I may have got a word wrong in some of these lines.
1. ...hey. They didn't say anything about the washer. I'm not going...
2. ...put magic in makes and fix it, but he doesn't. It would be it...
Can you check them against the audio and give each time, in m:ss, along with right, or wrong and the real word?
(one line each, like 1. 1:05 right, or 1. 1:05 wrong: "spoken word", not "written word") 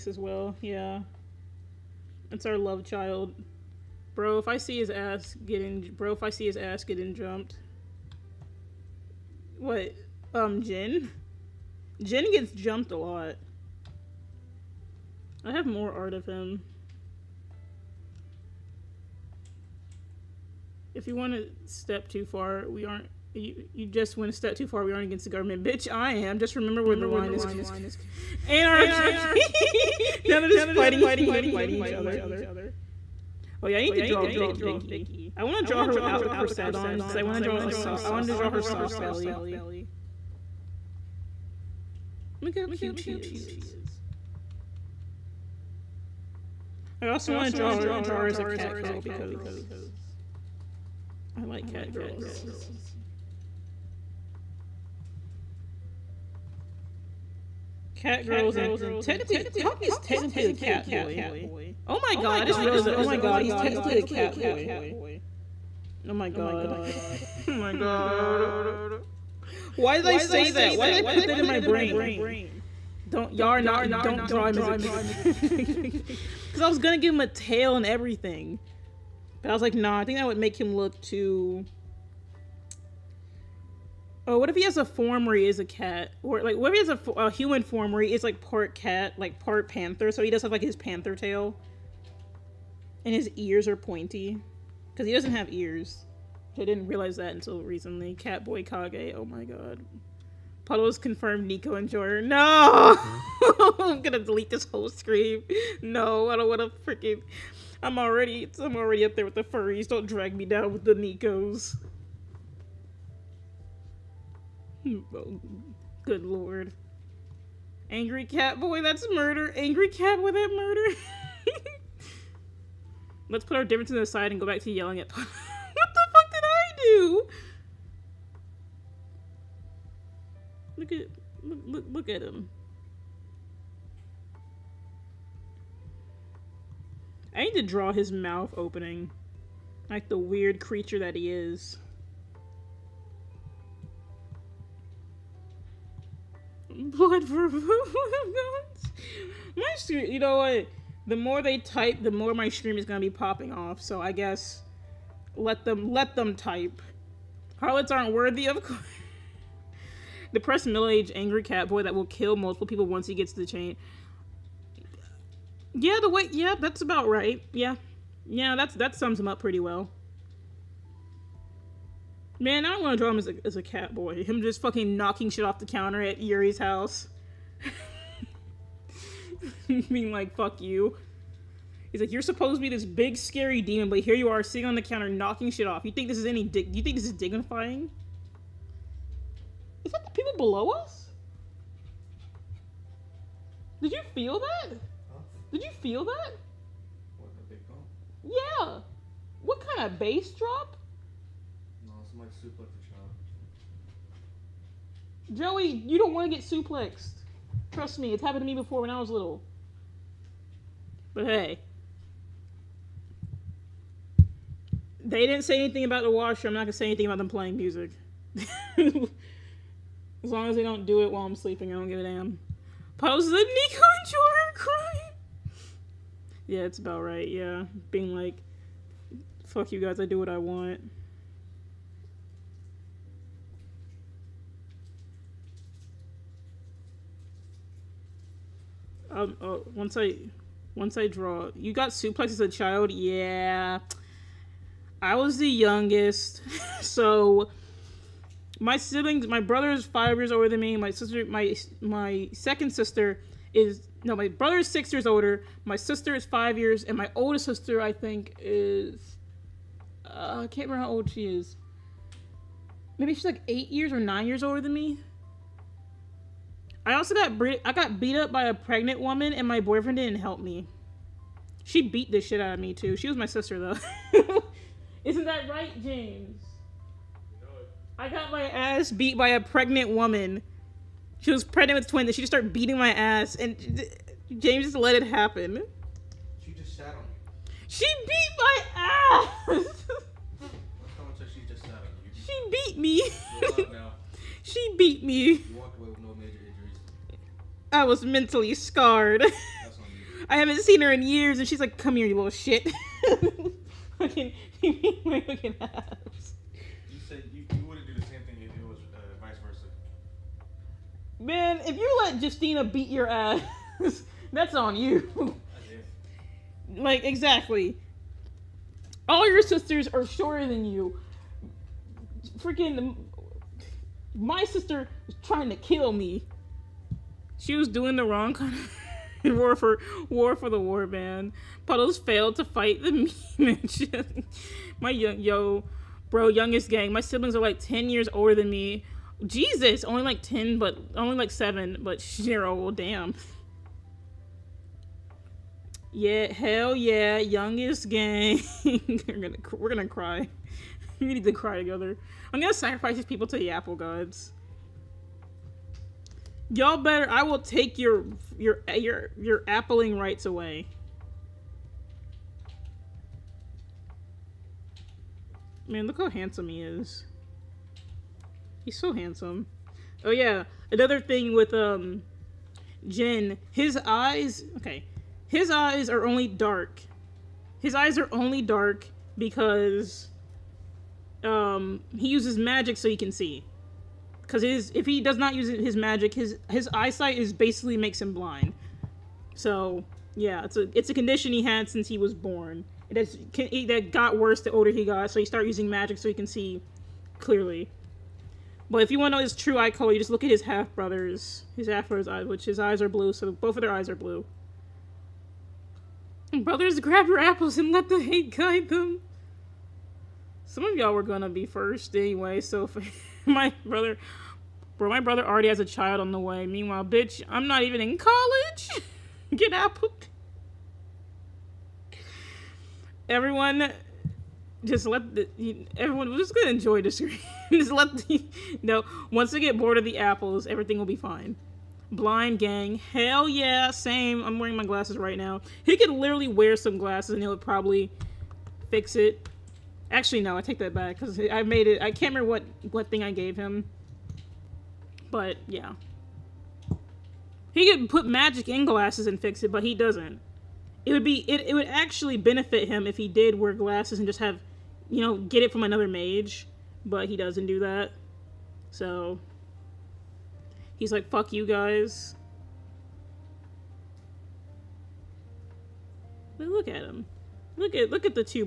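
1. 3:31 right
2. 7:27 wrong: "glasses", not "makes".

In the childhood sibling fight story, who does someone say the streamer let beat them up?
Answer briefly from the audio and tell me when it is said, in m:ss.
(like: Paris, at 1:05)
Justina, at 5:12.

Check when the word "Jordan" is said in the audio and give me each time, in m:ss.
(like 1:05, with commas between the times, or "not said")
1:41, 3:44.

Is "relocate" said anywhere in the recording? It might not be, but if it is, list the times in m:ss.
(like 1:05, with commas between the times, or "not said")
not said.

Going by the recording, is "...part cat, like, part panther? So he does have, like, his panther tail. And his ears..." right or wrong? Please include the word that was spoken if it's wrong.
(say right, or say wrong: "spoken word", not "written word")
right.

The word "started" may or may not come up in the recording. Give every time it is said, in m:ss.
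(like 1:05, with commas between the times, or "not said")
4:42, 6:35.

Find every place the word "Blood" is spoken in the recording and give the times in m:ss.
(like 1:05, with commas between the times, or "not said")
2:26.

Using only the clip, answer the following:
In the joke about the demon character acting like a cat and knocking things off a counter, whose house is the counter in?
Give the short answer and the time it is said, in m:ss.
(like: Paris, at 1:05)
Yuri's house, at 2:56.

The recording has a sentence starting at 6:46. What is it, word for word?
Brothers, grab your apples and let the hate guide them.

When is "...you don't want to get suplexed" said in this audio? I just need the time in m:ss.
3:25.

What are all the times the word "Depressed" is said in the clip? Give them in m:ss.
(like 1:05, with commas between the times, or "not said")
2:40.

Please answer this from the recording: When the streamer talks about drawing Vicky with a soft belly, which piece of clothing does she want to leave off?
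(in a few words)
Corset.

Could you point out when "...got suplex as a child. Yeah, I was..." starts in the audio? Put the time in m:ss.
4:01.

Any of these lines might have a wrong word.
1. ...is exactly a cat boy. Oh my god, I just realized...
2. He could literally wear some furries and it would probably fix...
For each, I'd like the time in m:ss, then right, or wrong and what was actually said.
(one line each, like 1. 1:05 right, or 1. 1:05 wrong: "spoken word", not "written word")
1. 0:59 wrong: "technically", not "exactly"
2. 7:15 wrong: "glasses", not "furries".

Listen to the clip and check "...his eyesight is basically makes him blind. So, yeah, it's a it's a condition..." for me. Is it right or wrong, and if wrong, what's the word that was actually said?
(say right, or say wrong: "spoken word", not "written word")
right.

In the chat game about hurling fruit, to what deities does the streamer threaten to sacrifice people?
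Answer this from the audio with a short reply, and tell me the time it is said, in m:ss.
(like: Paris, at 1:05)
The apple gods, at 5:53.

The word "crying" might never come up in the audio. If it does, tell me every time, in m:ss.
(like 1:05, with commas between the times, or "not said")
3:44.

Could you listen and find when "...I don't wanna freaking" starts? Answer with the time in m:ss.
1:46.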